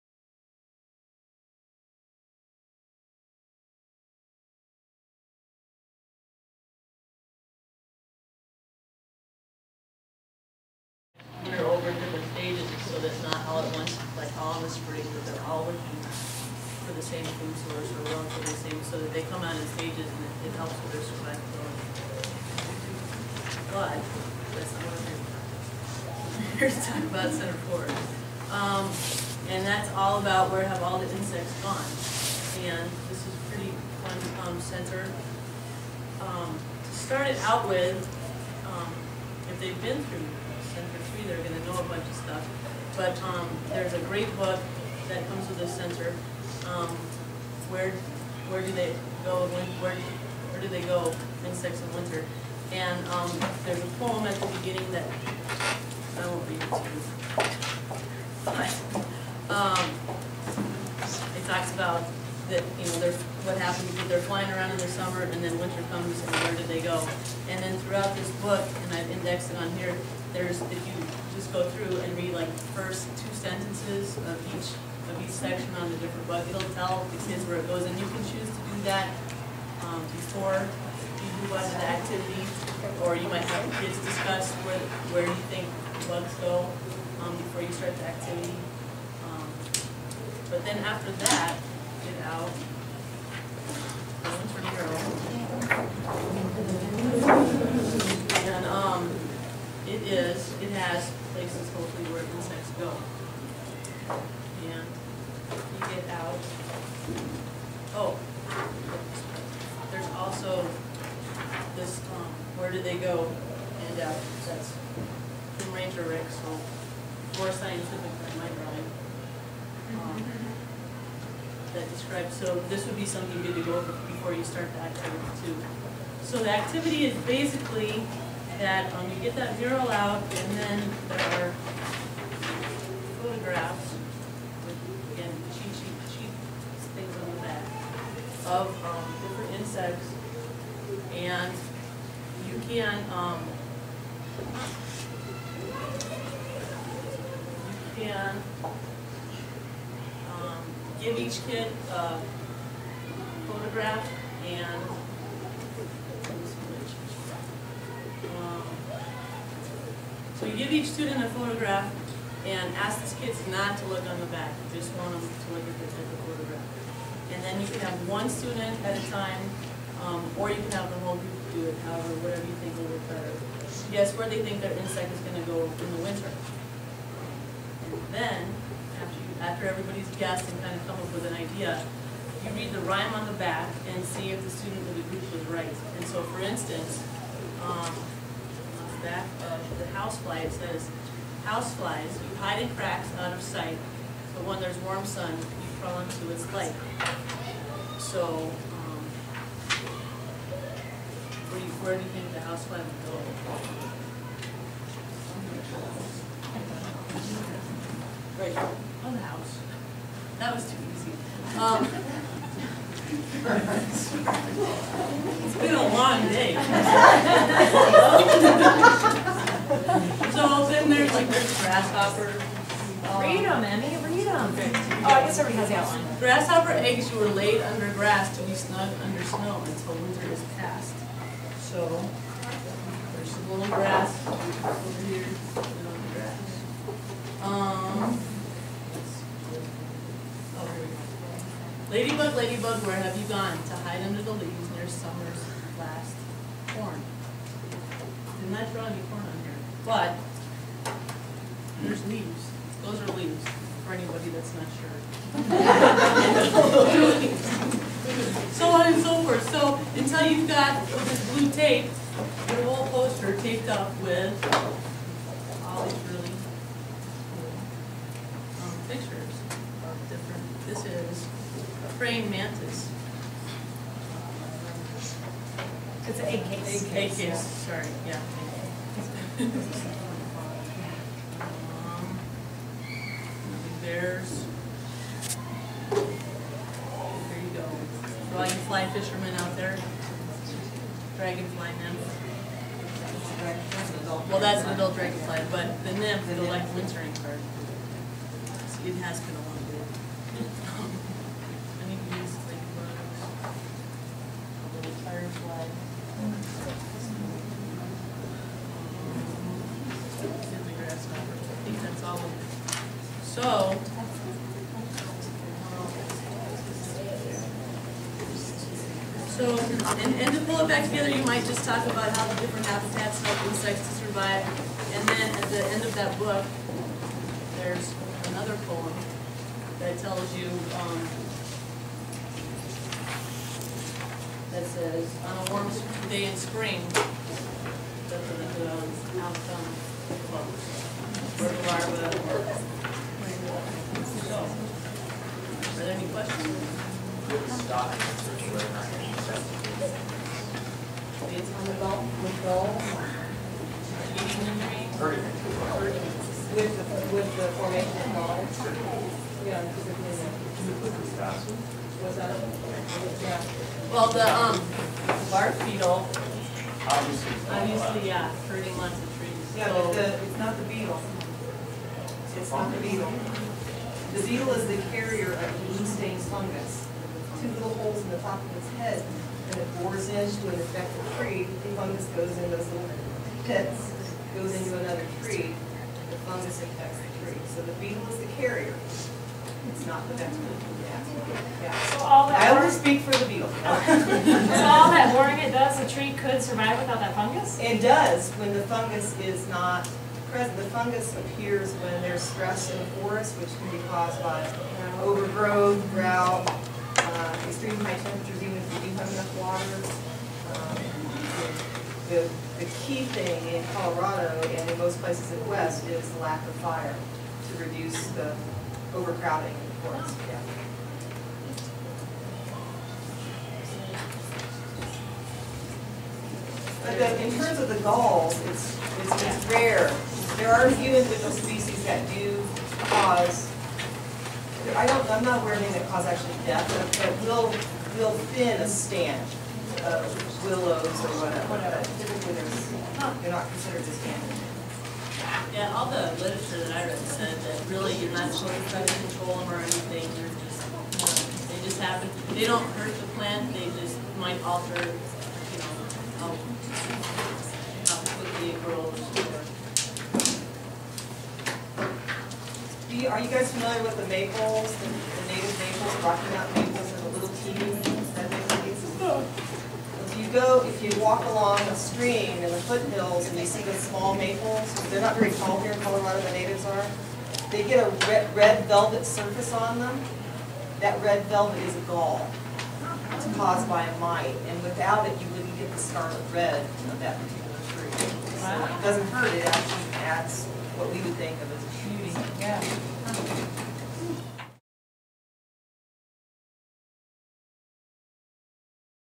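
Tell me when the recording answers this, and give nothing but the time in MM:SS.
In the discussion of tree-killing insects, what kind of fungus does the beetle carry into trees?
06:15.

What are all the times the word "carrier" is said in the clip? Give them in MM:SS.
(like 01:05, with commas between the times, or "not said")
06:14, 06:28.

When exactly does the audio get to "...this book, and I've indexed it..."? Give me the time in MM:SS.
01:08.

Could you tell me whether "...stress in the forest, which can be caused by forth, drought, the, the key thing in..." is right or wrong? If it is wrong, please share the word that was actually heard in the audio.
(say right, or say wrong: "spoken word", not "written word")
wrong: "overgrowth", not "forth".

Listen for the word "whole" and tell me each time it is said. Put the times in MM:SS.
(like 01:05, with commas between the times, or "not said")
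02:51, 04:22.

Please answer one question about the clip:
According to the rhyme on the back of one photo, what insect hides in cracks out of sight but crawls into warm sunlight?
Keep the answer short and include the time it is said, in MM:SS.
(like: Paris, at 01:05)
Housefly, at 03:11.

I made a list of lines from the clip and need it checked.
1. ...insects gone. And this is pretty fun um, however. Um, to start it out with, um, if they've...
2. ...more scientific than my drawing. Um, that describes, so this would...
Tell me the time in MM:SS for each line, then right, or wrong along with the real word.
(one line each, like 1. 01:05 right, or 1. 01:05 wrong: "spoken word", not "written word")
1. 00:31 wrong: "center", not "however"
2. 01:57 right.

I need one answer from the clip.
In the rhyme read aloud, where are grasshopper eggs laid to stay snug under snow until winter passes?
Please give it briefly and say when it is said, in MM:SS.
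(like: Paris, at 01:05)
Under grass, at 03:47.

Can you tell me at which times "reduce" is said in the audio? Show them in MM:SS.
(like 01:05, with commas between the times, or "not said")
06:57.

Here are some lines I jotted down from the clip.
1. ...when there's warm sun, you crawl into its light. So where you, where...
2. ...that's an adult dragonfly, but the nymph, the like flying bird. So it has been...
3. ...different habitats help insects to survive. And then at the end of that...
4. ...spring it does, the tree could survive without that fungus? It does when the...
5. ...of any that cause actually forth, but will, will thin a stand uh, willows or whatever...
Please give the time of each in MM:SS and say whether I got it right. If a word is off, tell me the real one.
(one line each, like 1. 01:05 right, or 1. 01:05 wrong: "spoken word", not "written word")
1. 03:14 right
2. 04:54 wrong: "wintering", not "flying"
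3. 05:22 right
4. 06:35 wrong: "boring", not "spring"
5. 07:15 wrong: "death", not "forth".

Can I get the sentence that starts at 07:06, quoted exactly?
But in terms of the galls, it's, it's, it's rare.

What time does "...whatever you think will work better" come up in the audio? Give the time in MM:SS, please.
02:52.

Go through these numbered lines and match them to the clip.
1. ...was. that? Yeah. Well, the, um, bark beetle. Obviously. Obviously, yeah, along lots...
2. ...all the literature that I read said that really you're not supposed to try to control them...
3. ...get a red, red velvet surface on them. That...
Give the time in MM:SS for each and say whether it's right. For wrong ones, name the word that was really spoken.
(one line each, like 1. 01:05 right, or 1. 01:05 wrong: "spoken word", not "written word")
1. 06:00 wrong: "hurting", not "along"
2. 07:25 right
3. 07:57 right.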